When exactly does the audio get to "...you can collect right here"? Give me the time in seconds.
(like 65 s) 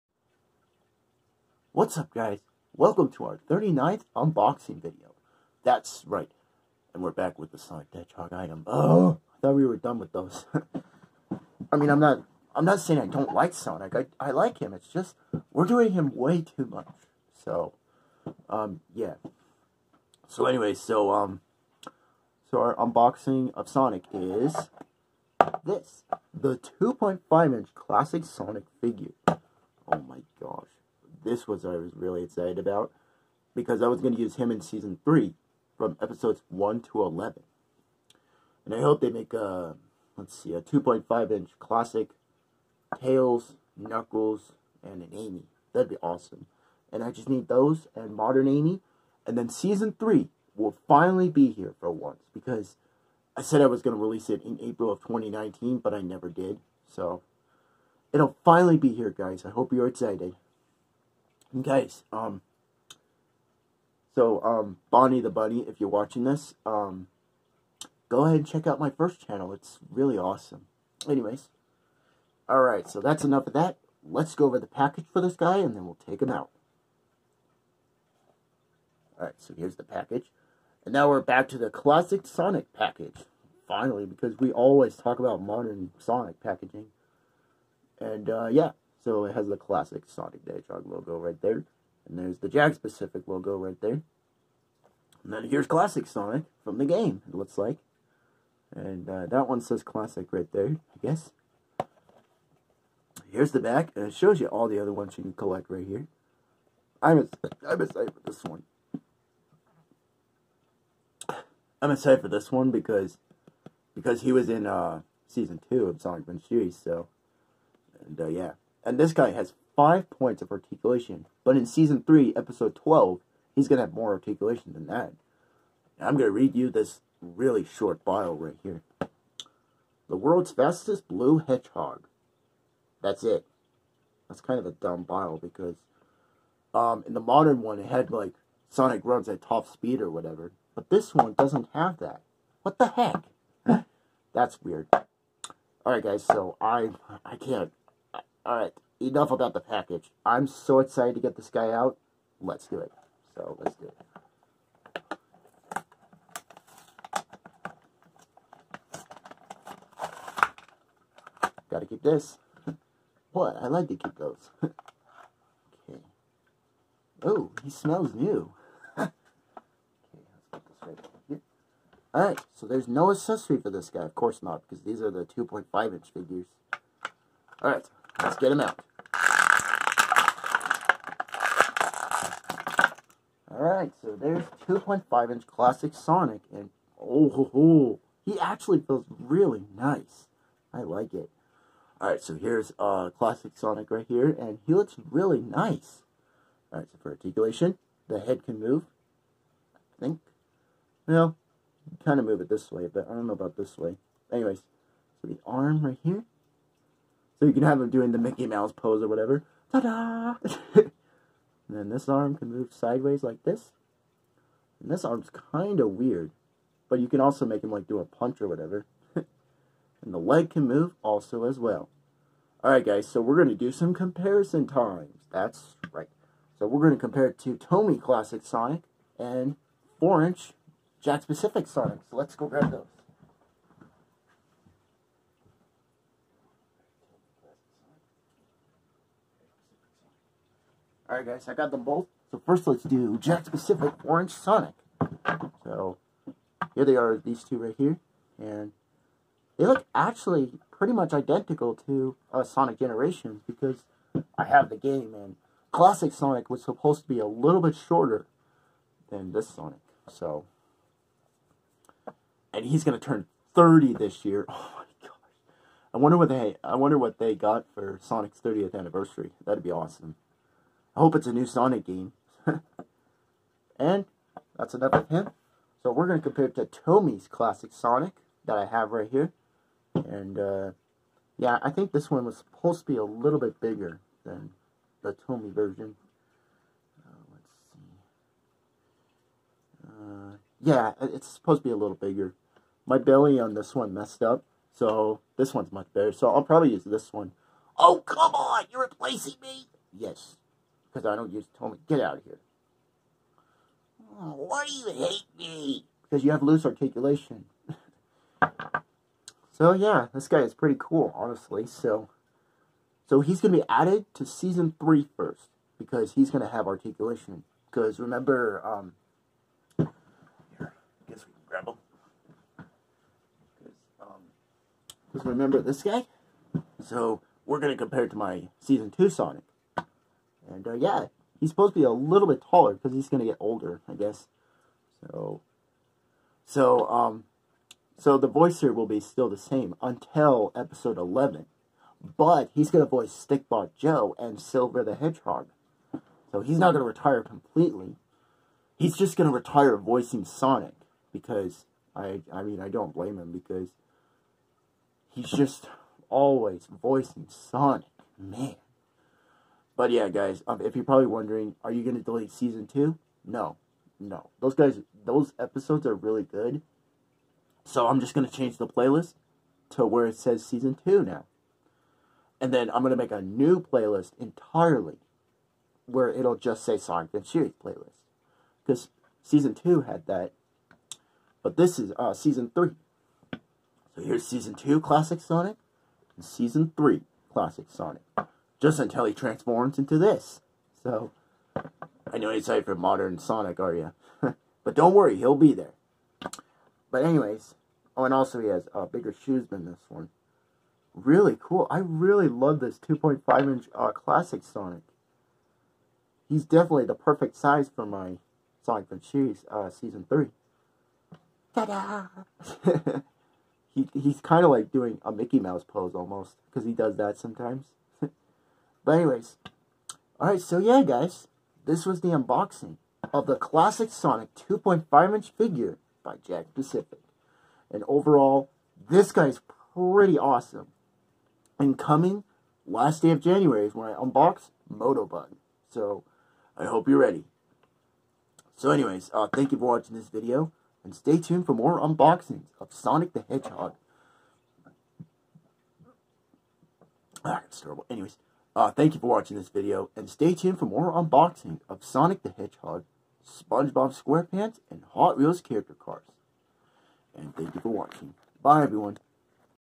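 105 s.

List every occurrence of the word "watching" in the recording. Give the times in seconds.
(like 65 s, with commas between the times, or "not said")
65 s, 439 s, 449 s, 457 s.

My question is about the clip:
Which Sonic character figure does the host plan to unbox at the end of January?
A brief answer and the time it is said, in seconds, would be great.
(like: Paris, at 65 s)
Motobug, at 434 s.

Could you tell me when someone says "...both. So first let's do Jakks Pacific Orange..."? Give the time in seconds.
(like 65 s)
241 s.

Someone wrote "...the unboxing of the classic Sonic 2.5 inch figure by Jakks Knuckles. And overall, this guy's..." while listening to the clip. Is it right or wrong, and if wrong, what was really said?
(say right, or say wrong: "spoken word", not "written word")
wrong: "Pacific", not "Knuckles".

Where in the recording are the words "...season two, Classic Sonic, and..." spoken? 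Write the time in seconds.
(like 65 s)
384 s.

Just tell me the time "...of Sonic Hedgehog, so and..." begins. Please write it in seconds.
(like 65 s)
115 s.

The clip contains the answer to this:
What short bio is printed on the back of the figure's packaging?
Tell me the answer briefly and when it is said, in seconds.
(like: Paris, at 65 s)
The world's fastest blue hedgehog, at 130 s.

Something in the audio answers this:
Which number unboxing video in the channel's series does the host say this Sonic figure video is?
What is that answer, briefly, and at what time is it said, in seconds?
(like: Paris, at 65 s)
39th, at 3 s.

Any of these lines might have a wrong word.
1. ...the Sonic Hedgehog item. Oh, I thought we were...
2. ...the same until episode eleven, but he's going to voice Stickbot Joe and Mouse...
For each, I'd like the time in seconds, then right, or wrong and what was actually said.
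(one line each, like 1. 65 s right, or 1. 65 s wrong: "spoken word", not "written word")
1. 7 s right
2. 339 s wrong: "Silver", not "Mouse".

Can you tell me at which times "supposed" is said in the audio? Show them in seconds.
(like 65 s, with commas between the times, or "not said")
256 s, 282 s, 291 s, 331 s.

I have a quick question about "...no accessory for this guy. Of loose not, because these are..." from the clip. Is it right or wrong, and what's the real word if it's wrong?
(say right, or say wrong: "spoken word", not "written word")
wrong: "course", not "loose".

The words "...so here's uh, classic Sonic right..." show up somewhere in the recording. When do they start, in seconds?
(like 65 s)
192 s.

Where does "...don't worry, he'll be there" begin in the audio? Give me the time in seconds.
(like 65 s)
394 s.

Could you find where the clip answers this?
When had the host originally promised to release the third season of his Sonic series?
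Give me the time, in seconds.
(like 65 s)
54 s.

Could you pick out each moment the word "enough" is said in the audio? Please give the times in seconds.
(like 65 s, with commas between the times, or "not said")
73 s, 148 s, 274 s.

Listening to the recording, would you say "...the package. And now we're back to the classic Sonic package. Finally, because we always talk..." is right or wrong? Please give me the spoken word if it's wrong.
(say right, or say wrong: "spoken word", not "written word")
right.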